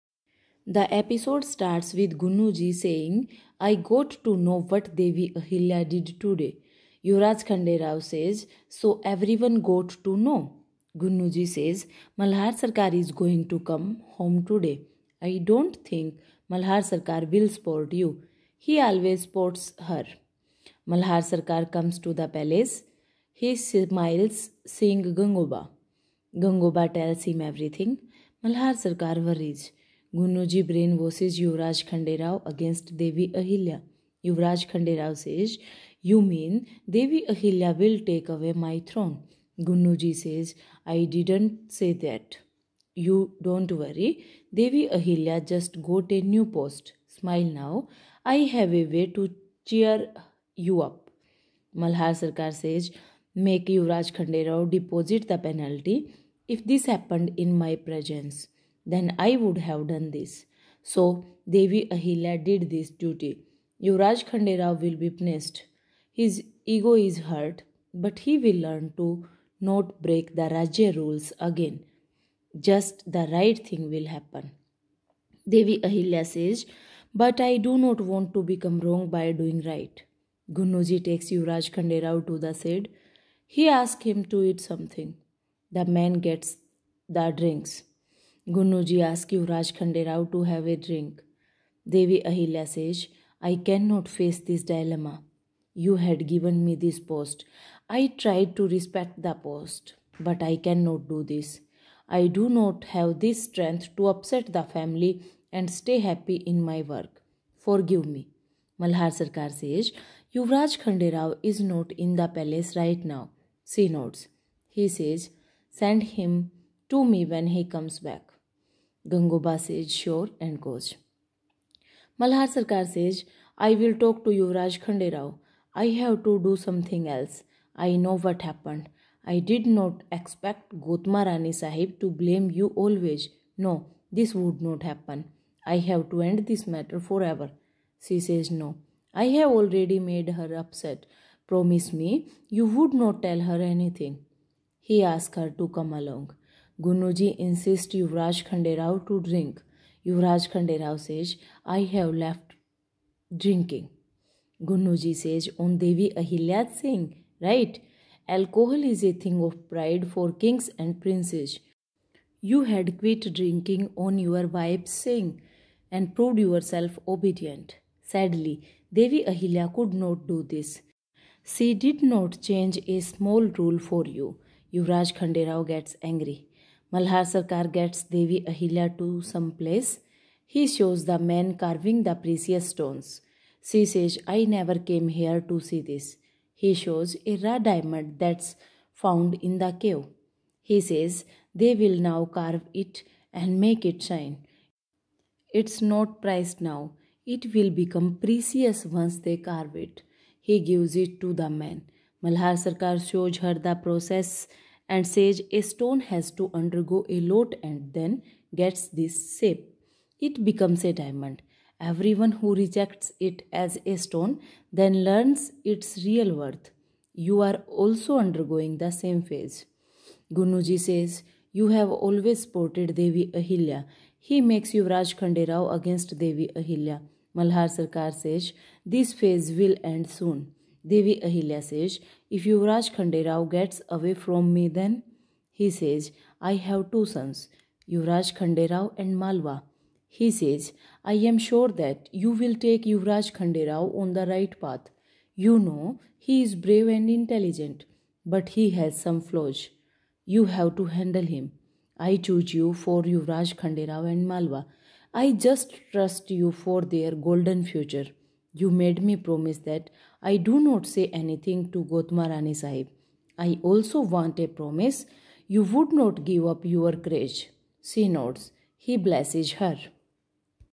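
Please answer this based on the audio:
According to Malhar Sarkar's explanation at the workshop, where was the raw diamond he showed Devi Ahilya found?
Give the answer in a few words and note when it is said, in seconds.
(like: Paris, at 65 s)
In the cave, at 188 s.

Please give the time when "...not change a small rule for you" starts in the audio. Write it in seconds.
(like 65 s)
172 s.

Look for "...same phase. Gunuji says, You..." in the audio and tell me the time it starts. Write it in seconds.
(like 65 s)
218 s.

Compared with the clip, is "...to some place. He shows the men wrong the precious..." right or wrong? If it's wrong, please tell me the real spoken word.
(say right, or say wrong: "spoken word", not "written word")
wrong: "carving", not "wrong".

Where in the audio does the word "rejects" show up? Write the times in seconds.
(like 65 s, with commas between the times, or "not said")
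212 s.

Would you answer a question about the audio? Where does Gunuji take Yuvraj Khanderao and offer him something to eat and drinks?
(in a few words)
The shed.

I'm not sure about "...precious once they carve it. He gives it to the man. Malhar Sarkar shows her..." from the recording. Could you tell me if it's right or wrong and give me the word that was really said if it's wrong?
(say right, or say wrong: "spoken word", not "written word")
right.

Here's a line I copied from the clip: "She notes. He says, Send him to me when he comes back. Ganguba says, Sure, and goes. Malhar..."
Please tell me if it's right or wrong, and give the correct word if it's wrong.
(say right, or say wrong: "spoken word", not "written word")
right.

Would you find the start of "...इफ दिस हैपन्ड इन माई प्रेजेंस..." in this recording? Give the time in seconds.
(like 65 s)
56 s.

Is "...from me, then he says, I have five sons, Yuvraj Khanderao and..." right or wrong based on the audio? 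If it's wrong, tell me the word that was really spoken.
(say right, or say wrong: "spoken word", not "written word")
wrong: "two", not "five".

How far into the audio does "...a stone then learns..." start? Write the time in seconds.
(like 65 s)
213 s.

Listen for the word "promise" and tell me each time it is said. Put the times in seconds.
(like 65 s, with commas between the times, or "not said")
141 s, 259 s, 264 s.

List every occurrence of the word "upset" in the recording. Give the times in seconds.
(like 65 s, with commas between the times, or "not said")
104 s, 140 s.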